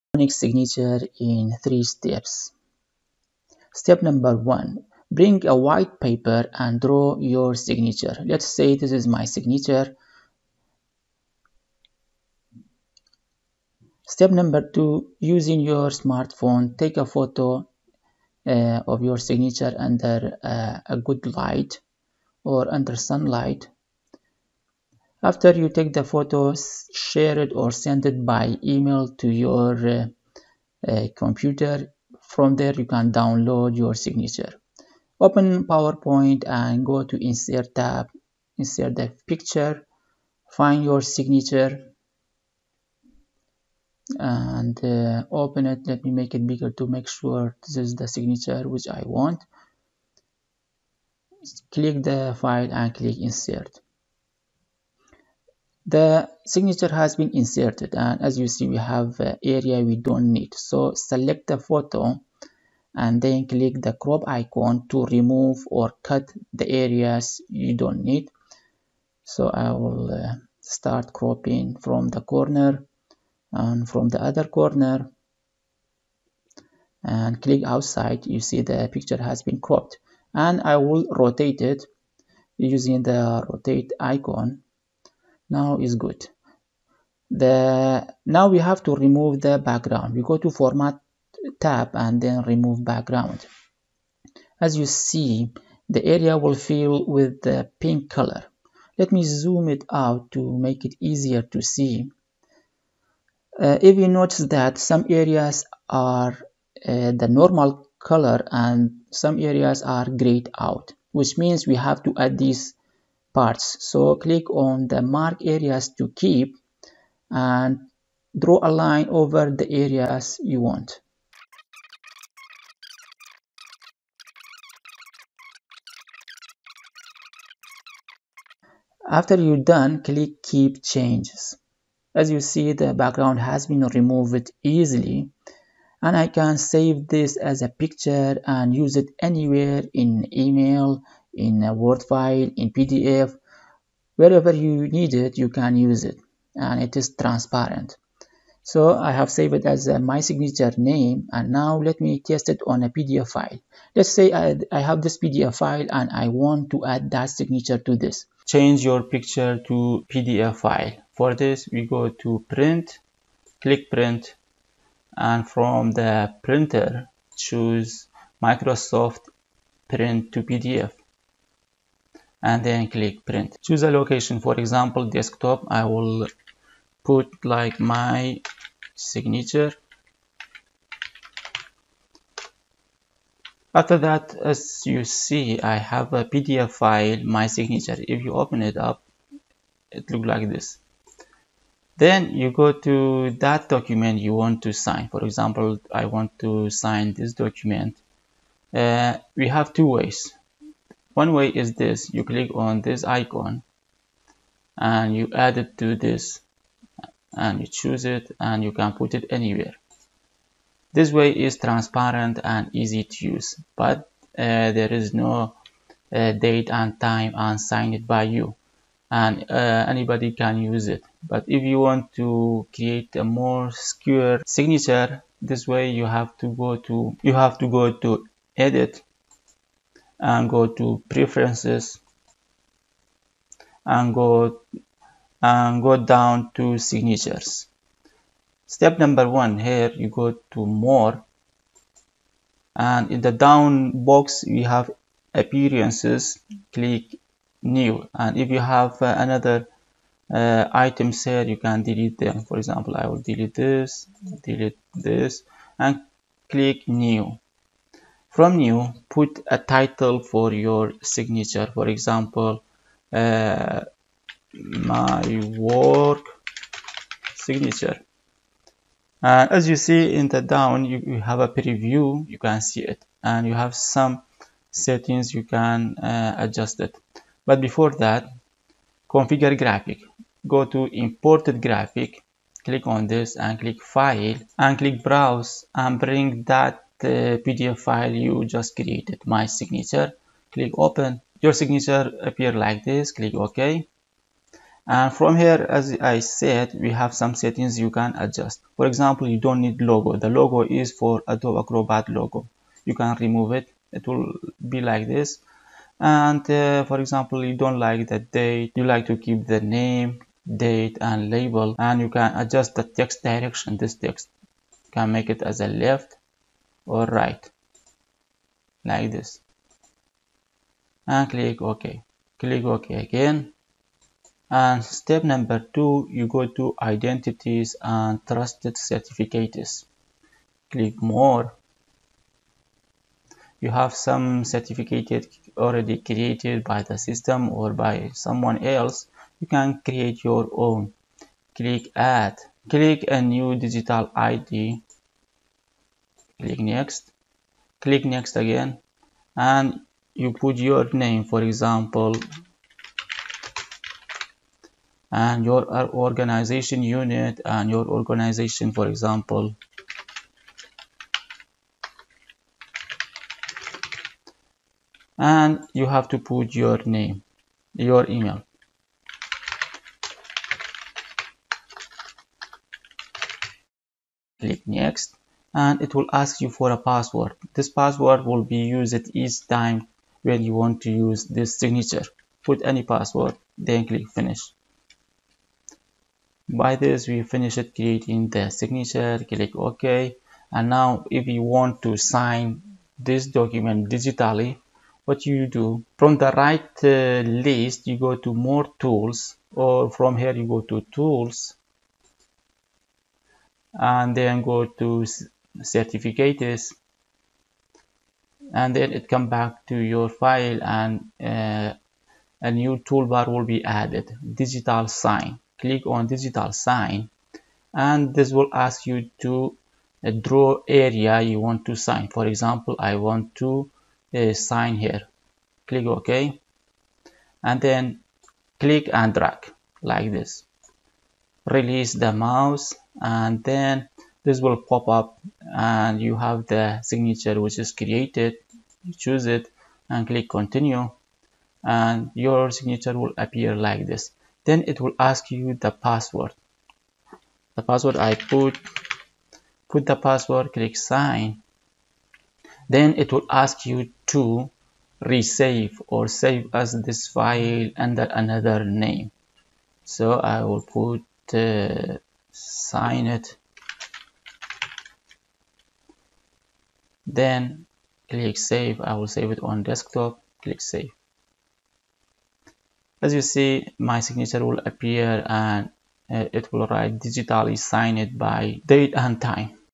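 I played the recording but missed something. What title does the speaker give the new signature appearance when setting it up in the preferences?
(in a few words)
my work signature.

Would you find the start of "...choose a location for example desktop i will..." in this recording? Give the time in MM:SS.
02:53.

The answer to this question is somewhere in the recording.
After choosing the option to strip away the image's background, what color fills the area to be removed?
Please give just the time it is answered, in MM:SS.
01:37.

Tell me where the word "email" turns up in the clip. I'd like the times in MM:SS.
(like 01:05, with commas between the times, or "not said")
00:28, 02:20, 06:08.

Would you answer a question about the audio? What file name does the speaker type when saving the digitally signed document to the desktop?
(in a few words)
sign it.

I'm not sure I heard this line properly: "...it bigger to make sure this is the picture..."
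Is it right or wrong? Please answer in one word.
wrong.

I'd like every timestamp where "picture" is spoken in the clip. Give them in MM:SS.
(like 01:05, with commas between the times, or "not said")
00:39, 01:18, 02:17, 02:39.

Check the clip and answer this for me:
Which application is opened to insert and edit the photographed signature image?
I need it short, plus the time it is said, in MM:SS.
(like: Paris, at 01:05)
PowerPoint, at 00:35.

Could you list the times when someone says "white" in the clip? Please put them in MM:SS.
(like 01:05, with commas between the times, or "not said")
00:05.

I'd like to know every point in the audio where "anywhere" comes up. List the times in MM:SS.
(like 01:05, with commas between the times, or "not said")
02:19, 03:29.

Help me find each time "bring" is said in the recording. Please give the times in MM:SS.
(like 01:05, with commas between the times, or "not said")
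00:05, 04:45.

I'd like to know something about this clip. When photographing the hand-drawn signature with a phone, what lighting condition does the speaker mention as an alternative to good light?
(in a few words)
sunlight.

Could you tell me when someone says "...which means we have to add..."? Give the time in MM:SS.
01:51.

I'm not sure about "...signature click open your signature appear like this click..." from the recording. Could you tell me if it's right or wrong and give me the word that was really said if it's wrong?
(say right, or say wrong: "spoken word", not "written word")
right.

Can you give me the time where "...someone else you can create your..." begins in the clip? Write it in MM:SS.
05:38.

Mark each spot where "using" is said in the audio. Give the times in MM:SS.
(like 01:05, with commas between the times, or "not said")
00:15, 01:22.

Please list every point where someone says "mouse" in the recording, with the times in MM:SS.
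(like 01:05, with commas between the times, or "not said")
07:12.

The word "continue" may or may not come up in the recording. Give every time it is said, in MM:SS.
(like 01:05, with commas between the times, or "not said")
07:20.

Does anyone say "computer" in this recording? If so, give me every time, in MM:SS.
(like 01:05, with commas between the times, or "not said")
00:31.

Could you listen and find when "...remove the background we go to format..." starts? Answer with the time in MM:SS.
01:29.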